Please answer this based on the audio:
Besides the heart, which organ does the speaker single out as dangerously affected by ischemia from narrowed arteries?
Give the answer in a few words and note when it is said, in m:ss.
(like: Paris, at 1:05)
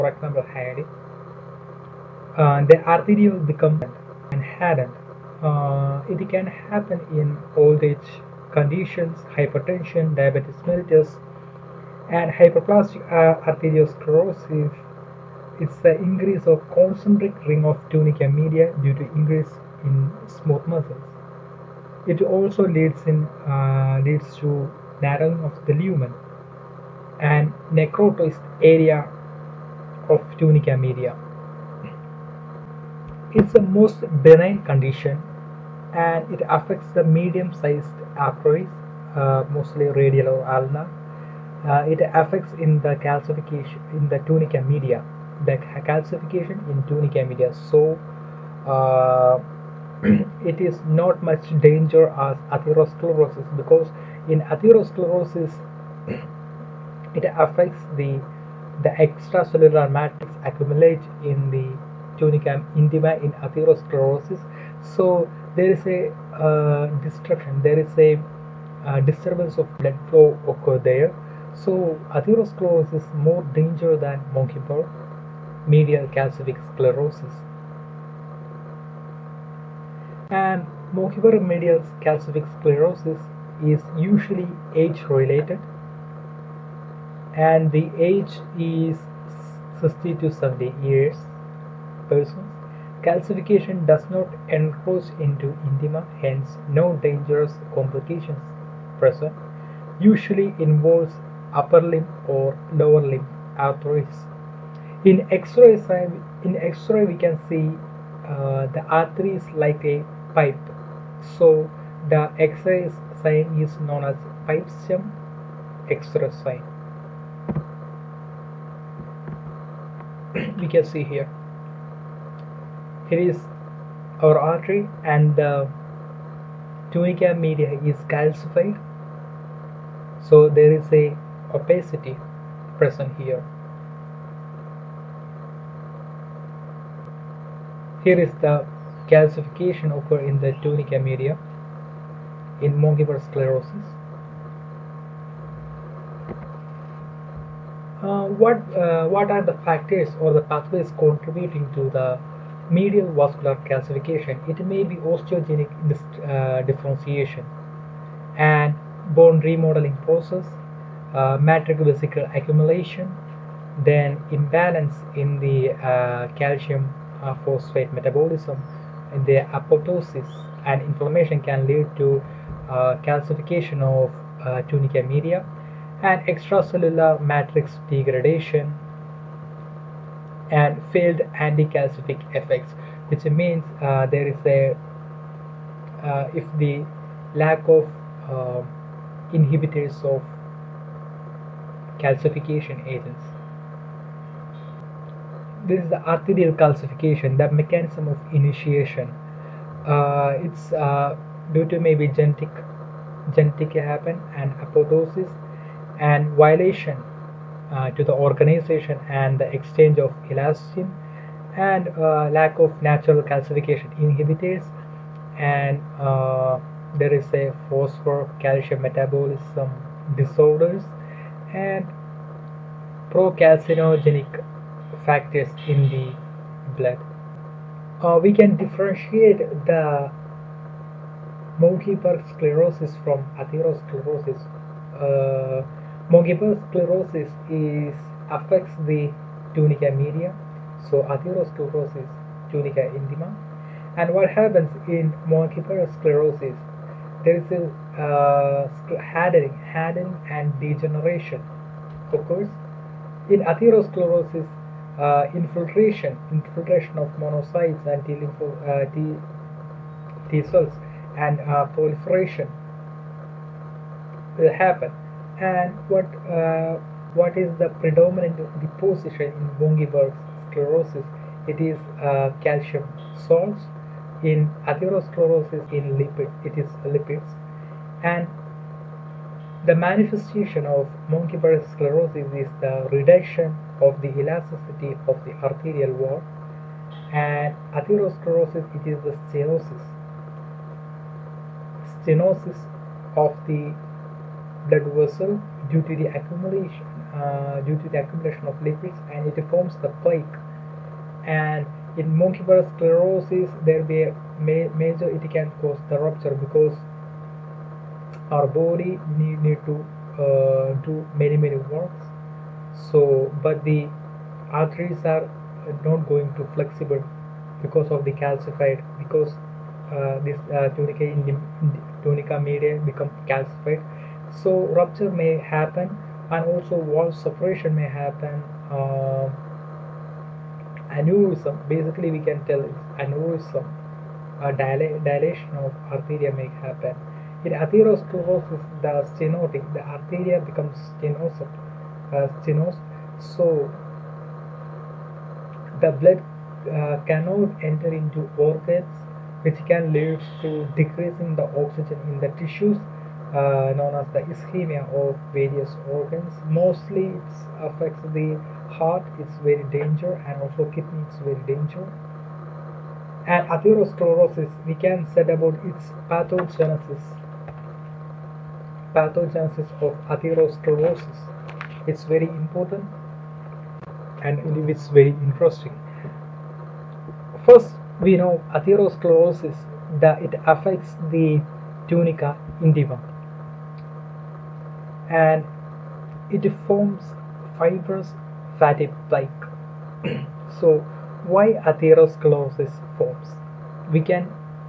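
kidney, at 6:00.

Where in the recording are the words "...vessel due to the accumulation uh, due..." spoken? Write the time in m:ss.
4:54.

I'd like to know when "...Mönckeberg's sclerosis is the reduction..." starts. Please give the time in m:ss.
4:41.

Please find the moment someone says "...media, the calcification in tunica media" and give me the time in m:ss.
0:44.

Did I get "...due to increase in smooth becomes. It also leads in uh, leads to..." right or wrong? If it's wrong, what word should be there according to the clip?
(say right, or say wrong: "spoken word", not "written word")
wrong: "muscles", not "becomes".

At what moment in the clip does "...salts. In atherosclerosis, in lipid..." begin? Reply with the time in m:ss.
4:33.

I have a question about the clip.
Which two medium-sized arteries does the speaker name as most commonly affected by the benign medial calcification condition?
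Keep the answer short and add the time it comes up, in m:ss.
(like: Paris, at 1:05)
radial or ulnar, at 0:39.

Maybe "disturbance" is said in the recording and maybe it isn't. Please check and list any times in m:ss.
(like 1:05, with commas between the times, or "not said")
1:08.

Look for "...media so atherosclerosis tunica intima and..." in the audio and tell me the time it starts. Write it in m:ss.
3:59.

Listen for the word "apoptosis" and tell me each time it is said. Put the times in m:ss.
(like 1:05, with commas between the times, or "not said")
2:49, 3:24.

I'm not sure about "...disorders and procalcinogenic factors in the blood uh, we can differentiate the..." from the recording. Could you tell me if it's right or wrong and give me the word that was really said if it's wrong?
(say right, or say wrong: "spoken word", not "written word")
right.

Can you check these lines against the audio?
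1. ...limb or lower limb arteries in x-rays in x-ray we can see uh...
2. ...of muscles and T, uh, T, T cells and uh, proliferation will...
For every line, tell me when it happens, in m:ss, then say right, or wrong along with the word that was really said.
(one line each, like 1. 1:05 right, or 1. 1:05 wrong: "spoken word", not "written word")
1. 1:41 right
2. 4:16 wrong: "monocytes", not "muscles".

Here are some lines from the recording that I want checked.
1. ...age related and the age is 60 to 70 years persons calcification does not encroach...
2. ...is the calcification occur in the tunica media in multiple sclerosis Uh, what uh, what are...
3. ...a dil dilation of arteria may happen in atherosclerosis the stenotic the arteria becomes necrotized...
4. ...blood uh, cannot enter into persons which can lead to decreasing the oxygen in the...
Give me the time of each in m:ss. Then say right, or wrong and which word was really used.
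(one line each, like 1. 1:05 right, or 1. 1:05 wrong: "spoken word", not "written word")
1. 1:24 right
2. 2:18 right
3. 5:34 wrong: "stenosed", not "necrotized"
4. 5:45 wrong: "organs", not "persons".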